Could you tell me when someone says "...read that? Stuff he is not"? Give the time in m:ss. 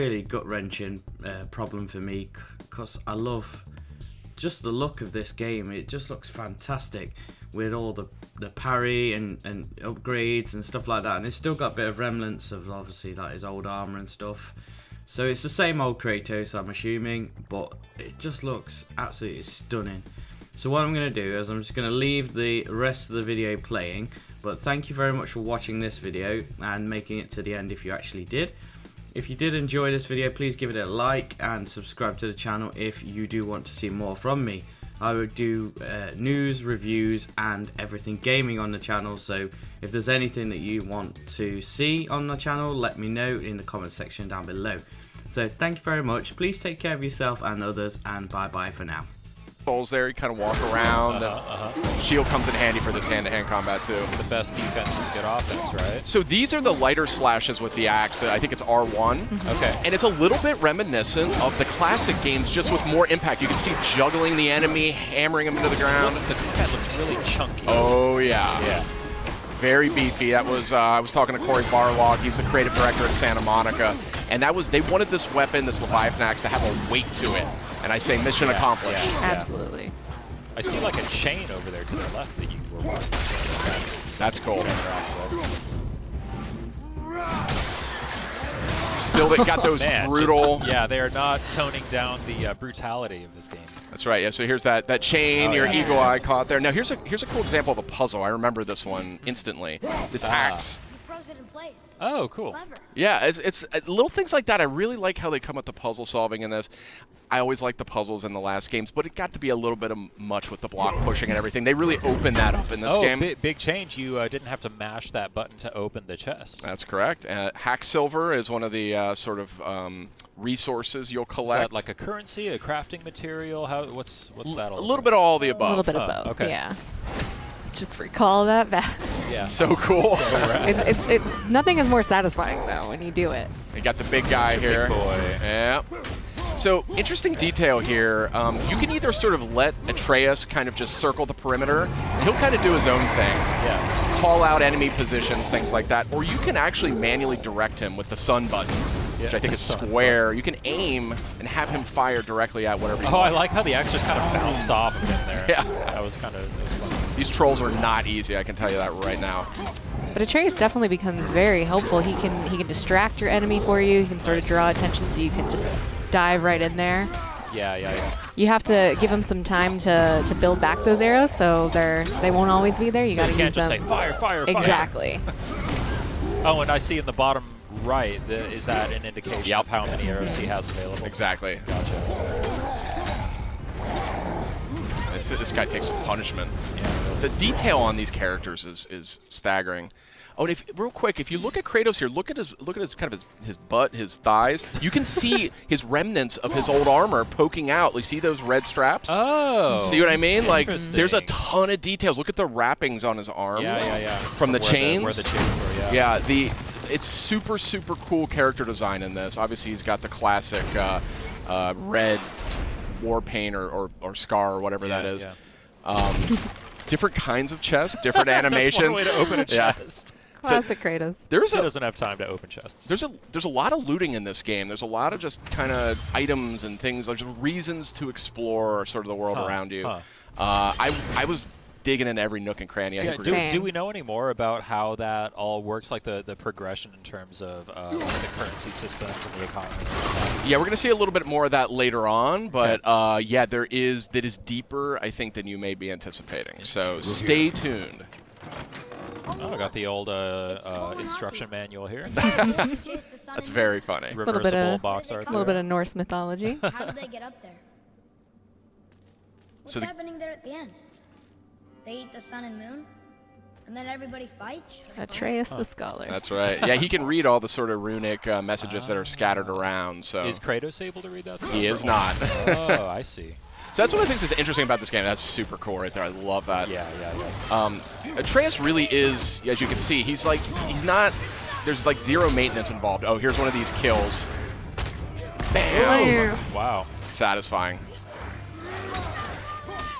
4:31.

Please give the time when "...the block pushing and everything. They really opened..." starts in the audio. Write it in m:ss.
1:50.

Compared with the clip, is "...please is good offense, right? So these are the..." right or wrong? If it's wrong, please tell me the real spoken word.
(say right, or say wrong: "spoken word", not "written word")
wrong: "defense", not "please".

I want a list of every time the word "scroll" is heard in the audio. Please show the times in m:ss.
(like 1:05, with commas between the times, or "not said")
not said.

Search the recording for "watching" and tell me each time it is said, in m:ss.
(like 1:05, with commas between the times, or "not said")
0:25, 1:22.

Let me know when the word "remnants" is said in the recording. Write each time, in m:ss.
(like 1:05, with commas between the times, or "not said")
0:11, 3:15.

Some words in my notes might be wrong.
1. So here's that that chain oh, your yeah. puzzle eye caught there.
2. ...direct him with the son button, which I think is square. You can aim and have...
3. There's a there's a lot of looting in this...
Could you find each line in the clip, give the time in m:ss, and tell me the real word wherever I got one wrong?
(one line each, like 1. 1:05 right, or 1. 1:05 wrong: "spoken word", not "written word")
1. 1:34 wrong: "eagle", not "puzzle"
2. 2:27 right
3. 3:42 right.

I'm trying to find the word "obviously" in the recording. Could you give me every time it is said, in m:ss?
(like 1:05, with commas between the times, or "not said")
0:12, 3:29.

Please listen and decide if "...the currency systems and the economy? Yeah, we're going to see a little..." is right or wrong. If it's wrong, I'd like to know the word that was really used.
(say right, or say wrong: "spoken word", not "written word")
right.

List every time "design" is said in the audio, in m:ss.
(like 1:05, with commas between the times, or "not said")
3:28.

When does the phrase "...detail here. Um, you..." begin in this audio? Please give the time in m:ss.
2:17.